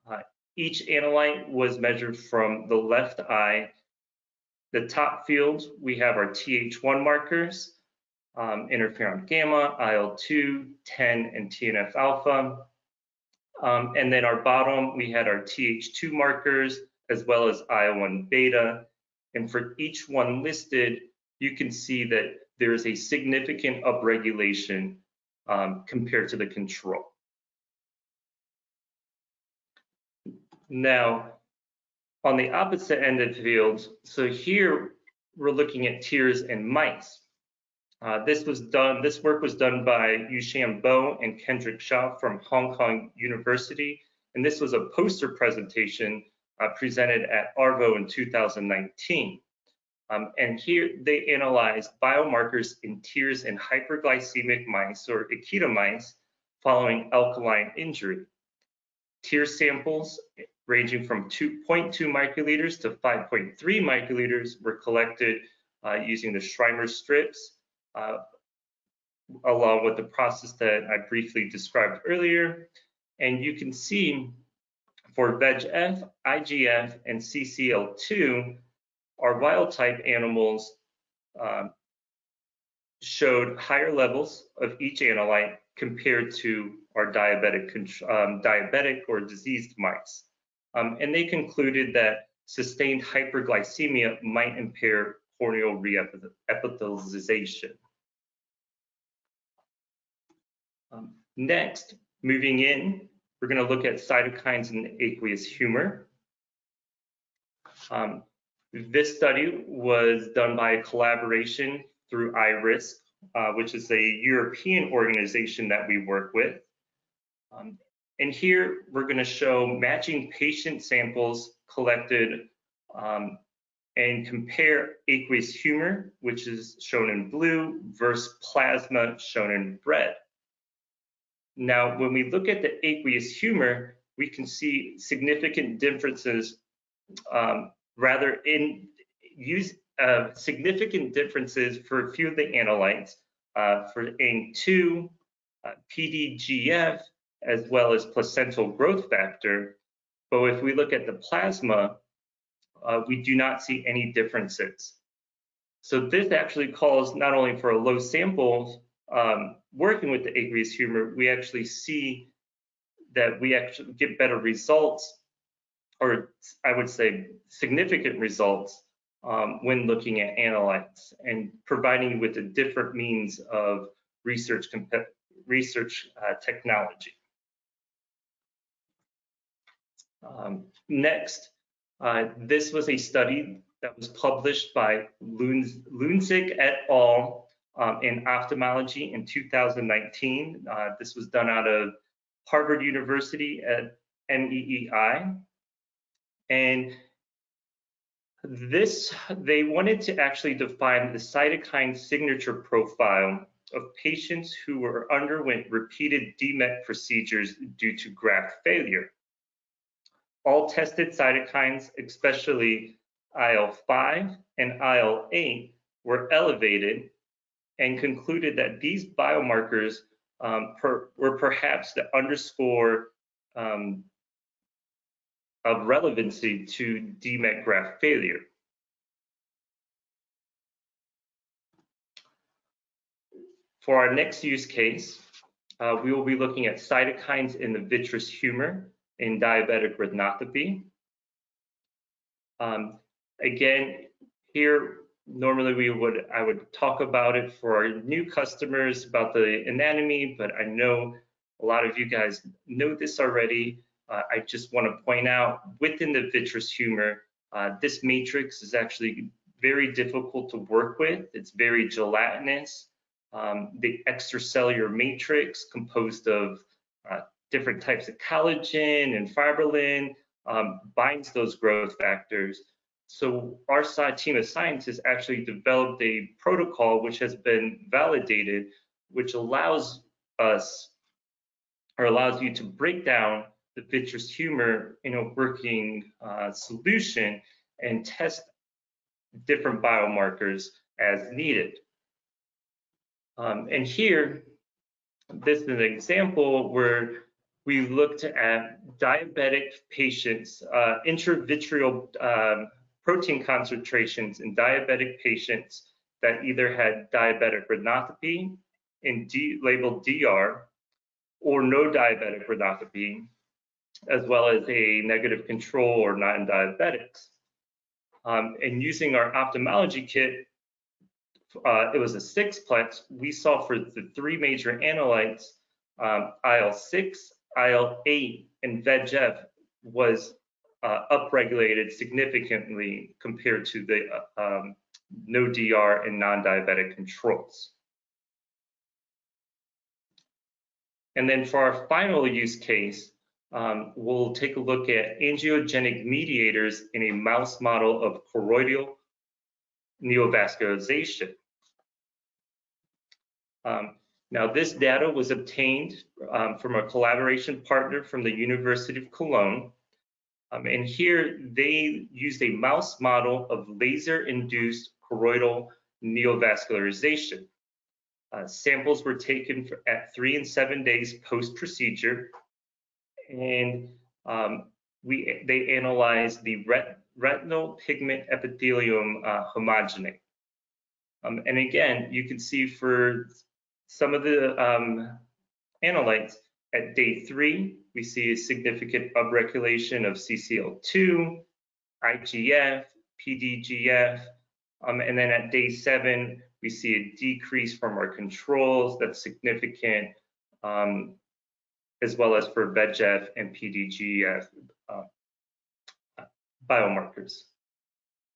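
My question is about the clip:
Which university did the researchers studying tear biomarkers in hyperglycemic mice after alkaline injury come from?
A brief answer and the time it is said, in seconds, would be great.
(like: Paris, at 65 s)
Hong Kong University, at 42 s.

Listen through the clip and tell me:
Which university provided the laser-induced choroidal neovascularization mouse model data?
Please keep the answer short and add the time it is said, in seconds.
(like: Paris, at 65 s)
University of Cologne, at 358 s.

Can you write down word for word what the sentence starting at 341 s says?
And then for our final use case, um, we'll take a look at angiogenic mediators in a mouse model of choroidal neovascularization.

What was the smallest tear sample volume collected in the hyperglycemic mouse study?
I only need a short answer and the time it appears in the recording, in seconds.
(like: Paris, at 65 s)
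2.2 microliters, at 61 s.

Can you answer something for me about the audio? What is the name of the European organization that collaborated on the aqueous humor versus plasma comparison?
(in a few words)
iRisk.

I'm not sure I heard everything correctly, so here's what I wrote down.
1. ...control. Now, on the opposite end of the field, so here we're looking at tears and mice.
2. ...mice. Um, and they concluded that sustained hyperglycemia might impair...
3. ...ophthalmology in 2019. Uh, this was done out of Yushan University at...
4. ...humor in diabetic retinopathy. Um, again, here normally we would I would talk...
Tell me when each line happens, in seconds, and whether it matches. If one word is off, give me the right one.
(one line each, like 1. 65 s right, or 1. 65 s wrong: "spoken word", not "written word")
1. 26 s right
2. 89 s right
3. 188 s wrong: "Harvard", not "Yushan"
4. 238 s right.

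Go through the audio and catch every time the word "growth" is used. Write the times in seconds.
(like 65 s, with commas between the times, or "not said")
148 s, 271 s.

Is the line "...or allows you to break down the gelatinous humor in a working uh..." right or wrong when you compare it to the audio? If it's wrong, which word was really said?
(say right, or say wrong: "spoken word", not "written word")
wrong: "vitreous", not "gelatinous".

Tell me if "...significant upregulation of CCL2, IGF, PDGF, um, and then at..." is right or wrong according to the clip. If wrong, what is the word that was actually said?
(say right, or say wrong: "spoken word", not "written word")
right.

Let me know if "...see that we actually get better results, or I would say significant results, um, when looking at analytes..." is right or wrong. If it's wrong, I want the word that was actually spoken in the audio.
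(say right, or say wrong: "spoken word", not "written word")
right.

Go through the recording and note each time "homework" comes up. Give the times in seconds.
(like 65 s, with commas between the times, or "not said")
not said.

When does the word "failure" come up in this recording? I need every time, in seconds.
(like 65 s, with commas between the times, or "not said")
208 s, 228 s.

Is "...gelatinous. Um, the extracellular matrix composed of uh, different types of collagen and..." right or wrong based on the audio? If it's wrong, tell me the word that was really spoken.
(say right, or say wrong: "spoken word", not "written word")
right.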